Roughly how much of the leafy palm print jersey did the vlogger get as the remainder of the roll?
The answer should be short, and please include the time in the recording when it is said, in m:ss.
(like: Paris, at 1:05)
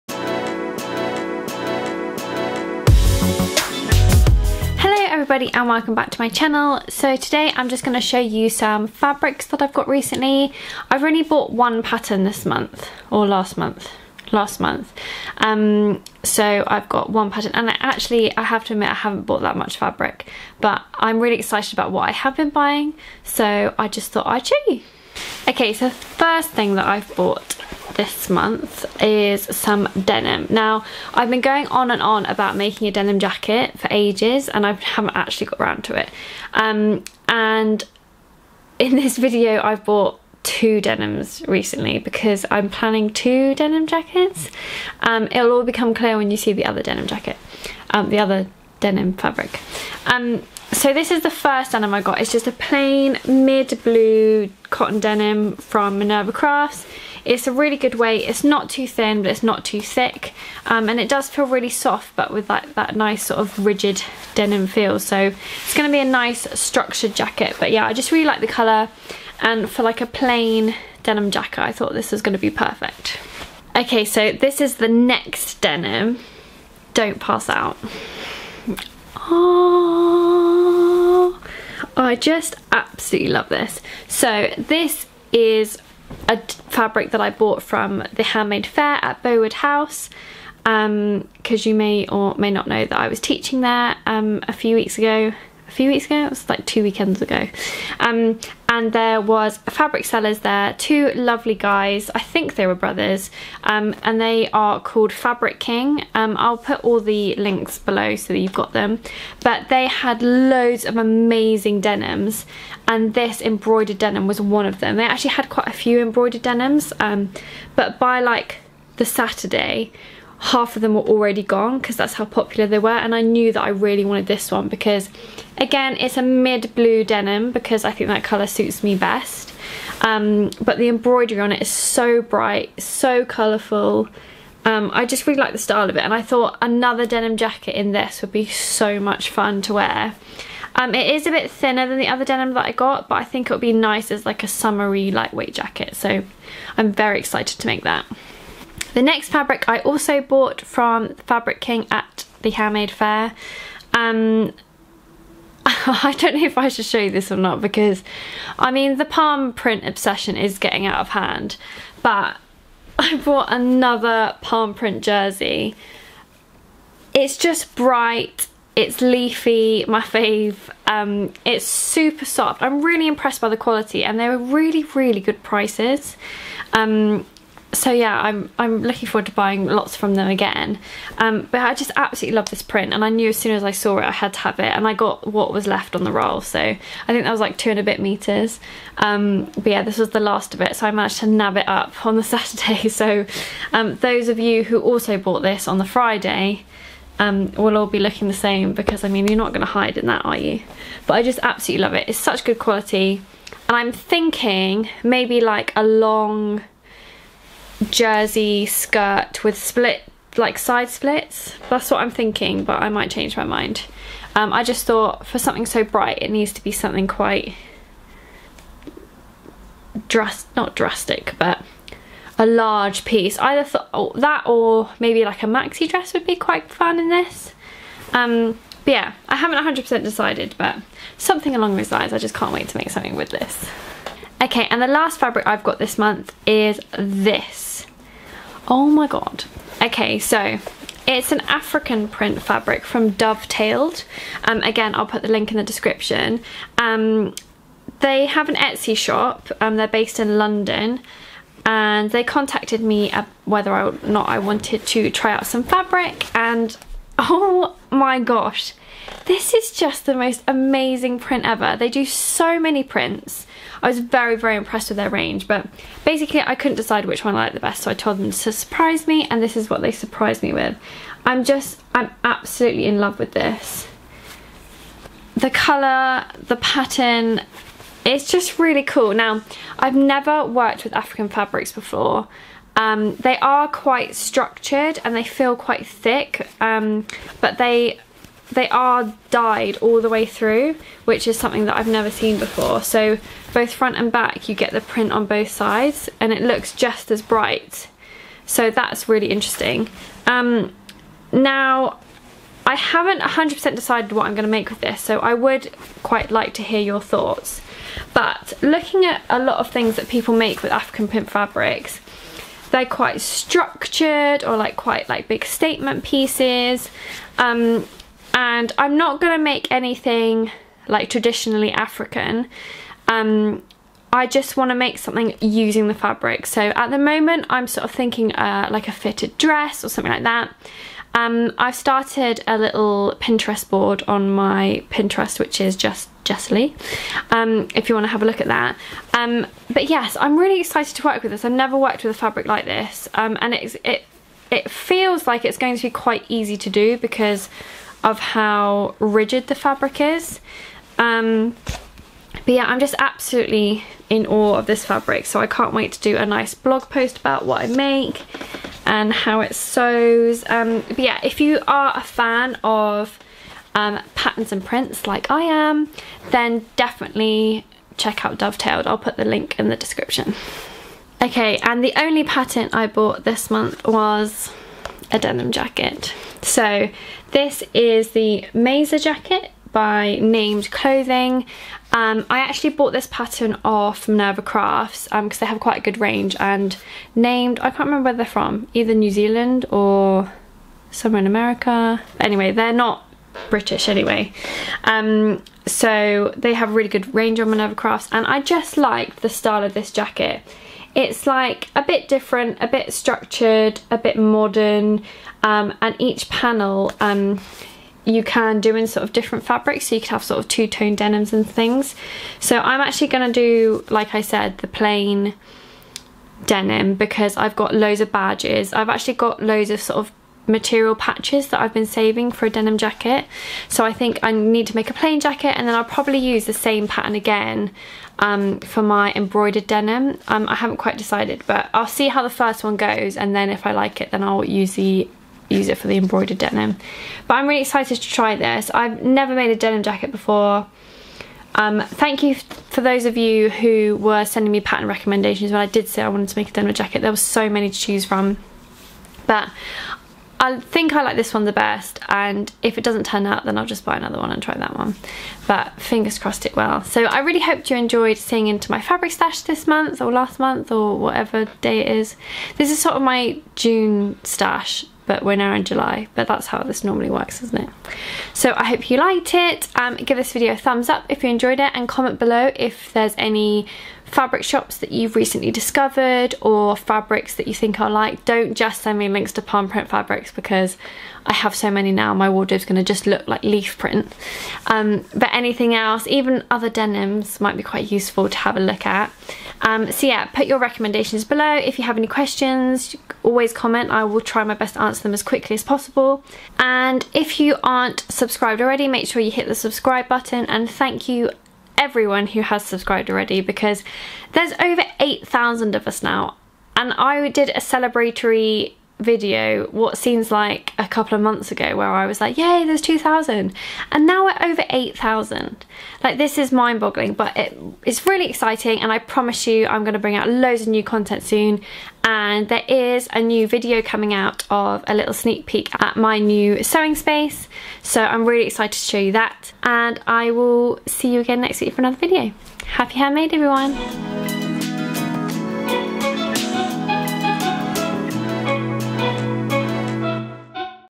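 2 and a bit meters, at 3:07.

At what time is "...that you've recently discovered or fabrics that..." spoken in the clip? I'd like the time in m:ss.
7:54.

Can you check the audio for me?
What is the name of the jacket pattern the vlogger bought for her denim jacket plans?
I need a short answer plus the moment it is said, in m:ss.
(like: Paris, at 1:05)
Maisa jacket, at 6:18.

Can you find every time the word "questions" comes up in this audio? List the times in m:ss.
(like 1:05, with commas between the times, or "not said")
8:12.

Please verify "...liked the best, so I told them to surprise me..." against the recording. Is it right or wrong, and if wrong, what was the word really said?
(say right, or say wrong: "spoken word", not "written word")
right.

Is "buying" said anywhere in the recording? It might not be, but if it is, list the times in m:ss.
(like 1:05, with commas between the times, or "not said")
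0:22, 2:59.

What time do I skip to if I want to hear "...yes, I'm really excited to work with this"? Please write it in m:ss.
5:39.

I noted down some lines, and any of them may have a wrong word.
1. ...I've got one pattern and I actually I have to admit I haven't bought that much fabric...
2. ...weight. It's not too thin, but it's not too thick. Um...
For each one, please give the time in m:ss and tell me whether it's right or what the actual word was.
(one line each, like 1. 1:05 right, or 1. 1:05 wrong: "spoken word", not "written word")
1. 0:16 right
2. 0:57 right.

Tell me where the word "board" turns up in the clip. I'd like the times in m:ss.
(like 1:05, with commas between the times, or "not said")
5:33.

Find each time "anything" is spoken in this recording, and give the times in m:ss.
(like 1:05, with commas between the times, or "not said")
5:19, 8:05.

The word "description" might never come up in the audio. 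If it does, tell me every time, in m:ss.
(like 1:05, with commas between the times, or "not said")
4:05, 6:09.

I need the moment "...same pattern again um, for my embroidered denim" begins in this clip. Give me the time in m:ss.
7:06.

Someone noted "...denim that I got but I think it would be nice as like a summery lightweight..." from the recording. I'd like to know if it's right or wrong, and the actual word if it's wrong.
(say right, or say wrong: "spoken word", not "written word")
right.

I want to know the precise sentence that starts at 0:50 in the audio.
Um, so this is the first denim I got.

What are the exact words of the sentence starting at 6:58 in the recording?
I've actually got loads of sort of material patches that I've been saving for a denim jacket.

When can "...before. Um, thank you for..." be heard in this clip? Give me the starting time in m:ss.
7:20.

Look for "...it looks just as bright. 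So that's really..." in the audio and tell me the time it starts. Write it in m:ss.
4:56.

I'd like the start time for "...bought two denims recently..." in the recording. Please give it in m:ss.
0:39.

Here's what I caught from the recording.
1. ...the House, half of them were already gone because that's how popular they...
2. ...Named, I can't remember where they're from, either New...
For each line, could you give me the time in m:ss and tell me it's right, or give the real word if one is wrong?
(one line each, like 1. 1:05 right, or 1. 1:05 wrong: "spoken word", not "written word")
1. 1:58 wrong: "Saturday", not "House"
2. 6:27 right.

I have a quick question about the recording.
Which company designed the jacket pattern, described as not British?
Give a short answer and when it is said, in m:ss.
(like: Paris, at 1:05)
Named Clothing, at 6:20.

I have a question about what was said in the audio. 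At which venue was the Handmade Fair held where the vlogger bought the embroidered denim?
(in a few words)
Bowood House.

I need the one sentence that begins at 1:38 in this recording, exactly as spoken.
Um, and there was fabric sellers there, two lovely guys, I think they were brothers, um, and they are called Fabric King.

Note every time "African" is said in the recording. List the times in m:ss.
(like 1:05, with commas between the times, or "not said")
4:01, 4:40, 5:10, 5:21.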